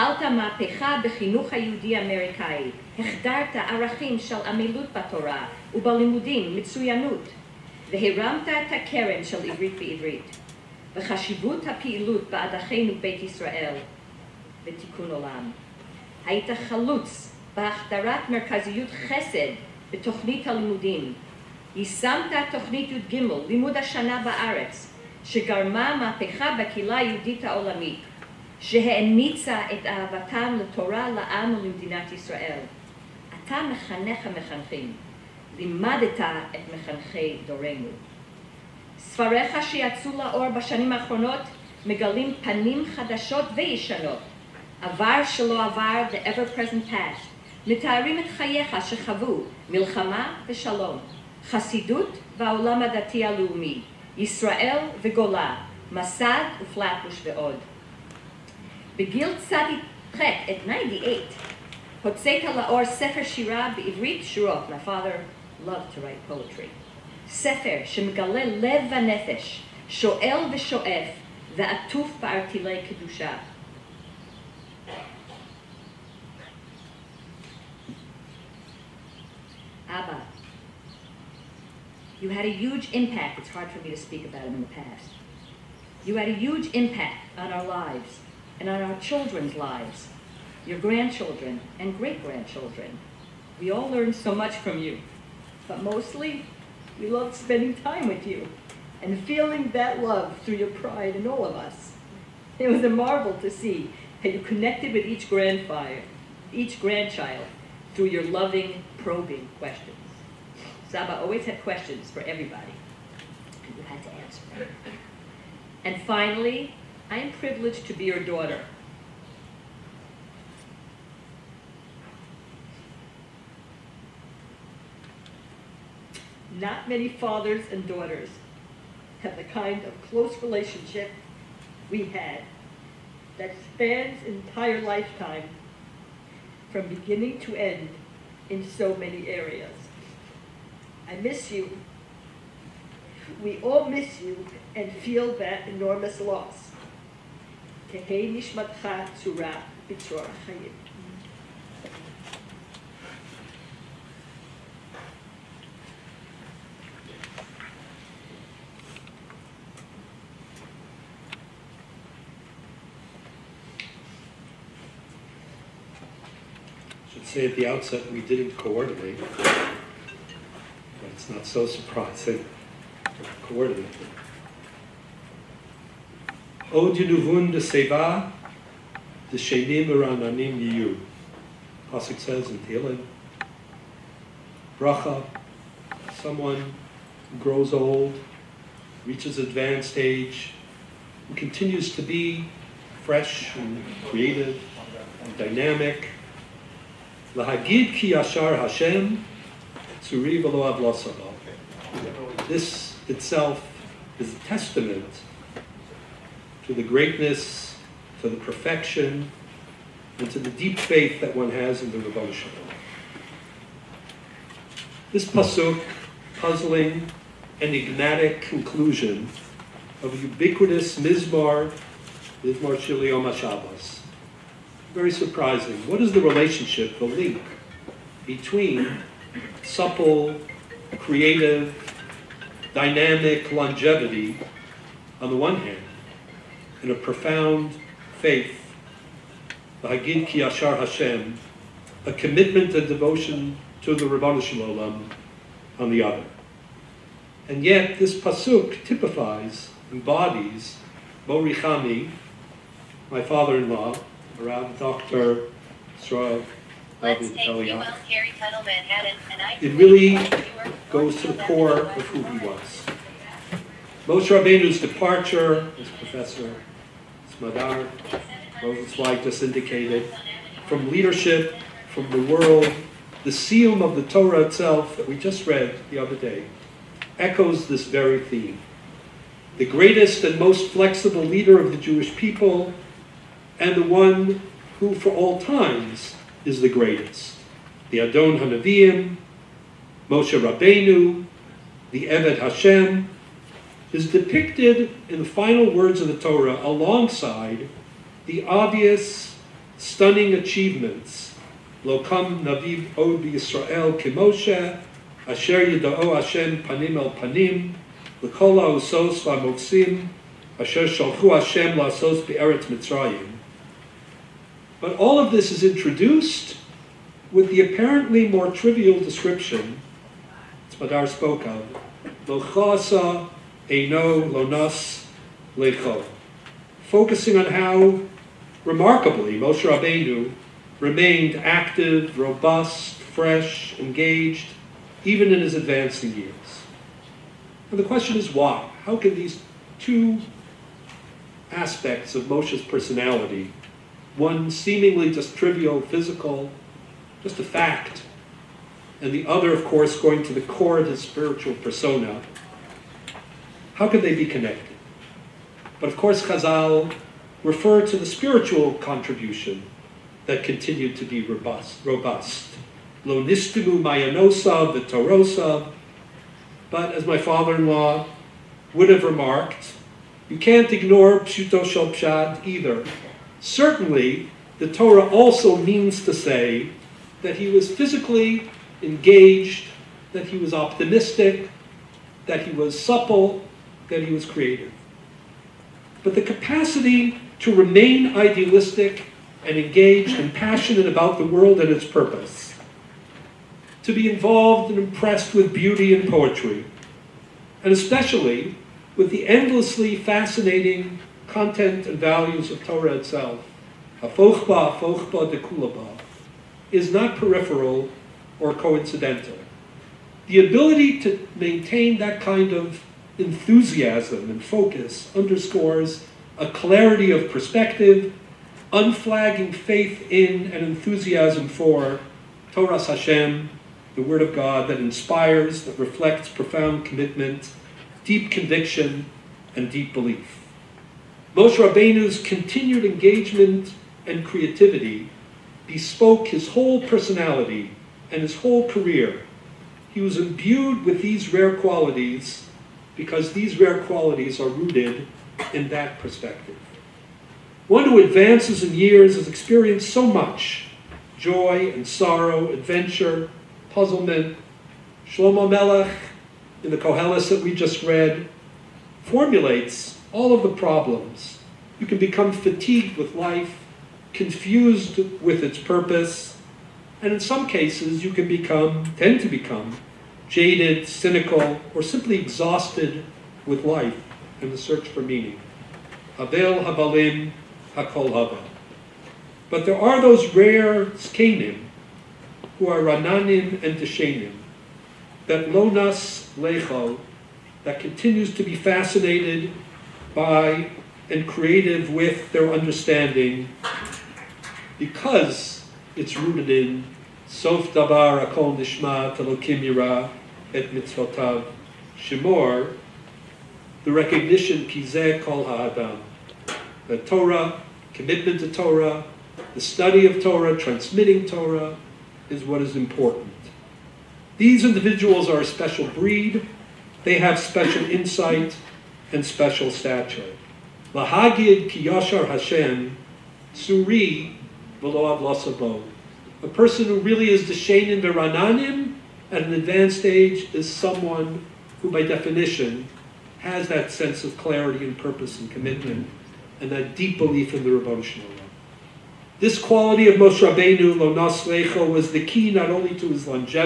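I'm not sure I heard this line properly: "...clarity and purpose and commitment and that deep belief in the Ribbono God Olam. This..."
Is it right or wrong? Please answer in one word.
wrong.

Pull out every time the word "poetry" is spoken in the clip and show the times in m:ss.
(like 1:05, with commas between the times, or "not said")
1:06, 6:36.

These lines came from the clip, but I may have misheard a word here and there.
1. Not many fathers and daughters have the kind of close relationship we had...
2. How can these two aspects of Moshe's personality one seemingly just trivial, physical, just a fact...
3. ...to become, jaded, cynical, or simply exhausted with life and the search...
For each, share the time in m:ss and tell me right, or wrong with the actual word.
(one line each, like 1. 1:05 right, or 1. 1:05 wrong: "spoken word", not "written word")
1. 2:06 right
2. 5:38 right
3. 7:49 right.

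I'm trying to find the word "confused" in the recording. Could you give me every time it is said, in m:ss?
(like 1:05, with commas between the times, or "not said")
7:44.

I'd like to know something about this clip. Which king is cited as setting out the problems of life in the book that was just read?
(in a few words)
Shlomo.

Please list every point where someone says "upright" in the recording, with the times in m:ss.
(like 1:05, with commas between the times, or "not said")
not said.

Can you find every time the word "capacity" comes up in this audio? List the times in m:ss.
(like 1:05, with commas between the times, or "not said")
6:26.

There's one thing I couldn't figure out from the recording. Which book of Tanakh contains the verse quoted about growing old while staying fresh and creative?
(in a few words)
Tehillim.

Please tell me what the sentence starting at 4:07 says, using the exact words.
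And yet this pasuk typifies, embodies, Morichami, my father-in-law, around Dr.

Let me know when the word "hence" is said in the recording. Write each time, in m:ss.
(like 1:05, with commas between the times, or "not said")
not said.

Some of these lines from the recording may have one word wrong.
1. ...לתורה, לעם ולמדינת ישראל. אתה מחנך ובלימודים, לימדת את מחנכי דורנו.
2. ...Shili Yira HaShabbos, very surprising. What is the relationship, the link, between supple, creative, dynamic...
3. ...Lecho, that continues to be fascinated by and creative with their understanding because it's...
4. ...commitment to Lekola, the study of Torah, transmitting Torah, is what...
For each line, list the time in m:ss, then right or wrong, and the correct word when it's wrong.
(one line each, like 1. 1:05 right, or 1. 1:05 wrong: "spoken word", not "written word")
1. 0:30 wrong: "המחנכים", not "ובלימודים"
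2. 3:42 wrong: "Yom", not "Yira"
3. 8:06 right
4. 8:27 wrong: "Torah", not "Lekola".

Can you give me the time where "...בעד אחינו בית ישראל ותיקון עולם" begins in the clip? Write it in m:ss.
0:12.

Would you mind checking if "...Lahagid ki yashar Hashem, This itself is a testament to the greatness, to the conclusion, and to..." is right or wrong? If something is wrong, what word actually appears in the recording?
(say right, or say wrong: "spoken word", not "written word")
wrong: "perfection", not "conclusion".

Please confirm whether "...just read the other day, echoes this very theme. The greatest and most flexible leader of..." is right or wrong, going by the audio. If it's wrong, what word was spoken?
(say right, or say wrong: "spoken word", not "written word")
right.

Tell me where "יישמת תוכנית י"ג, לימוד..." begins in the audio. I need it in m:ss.
0:21.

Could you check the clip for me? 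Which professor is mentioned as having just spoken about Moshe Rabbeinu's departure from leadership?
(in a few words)
Smadar Rosenzweig.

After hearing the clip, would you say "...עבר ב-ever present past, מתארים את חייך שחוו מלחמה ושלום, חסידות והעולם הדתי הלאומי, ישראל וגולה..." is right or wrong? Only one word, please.
right.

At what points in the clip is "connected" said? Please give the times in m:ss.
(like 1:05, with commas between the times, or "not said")
1:44, 5:54.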